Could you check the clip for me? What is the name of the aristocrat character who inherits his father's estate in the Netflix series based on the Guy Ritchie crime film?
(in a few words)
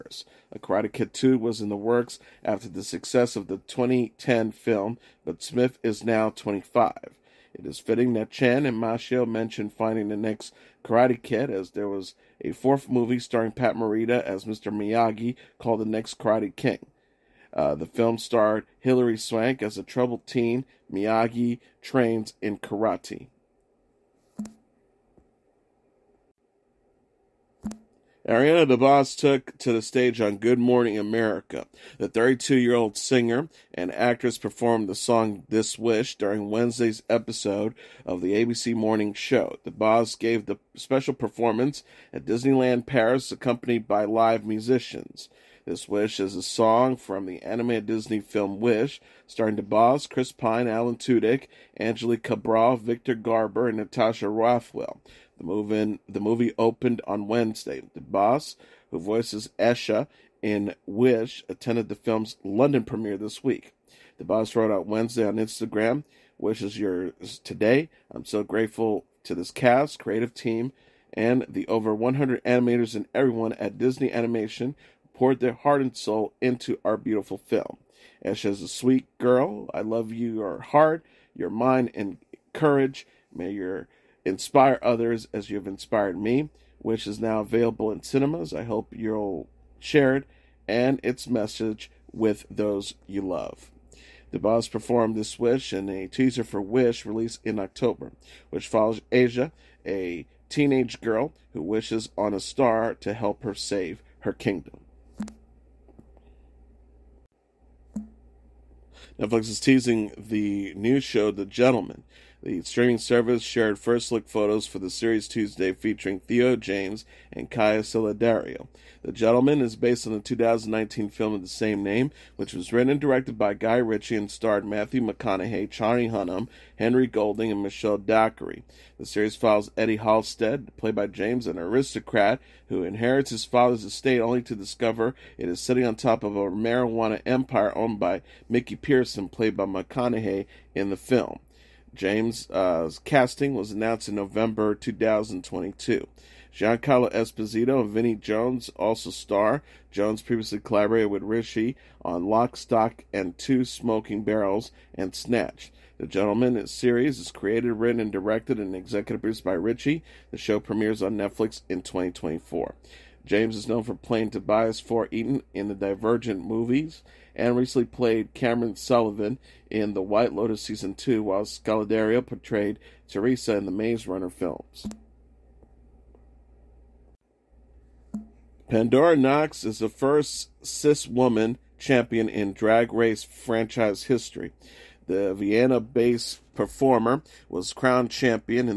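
Eddie Halstead.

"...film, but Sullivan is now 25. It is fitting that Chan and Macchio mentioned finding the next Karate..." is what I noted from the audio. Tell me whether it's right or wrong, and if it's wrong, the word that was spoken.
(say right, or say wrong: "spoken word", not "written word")
wrong: "Smith", not "Sullivan".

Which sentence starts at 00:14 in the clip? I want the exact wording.
Miyagi called The Next Karate King.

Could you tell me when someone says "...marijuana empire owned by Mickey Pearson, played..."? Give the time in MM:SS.
02:16.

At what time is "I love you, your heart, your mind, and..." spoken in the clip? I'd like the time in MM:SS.
01:19.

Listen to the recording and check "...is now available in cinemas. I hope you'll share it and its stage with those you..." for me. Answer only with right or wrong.
wrong.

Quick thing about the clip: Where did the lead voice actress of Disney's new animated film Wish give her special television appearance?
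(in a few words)
Disneyland Paris.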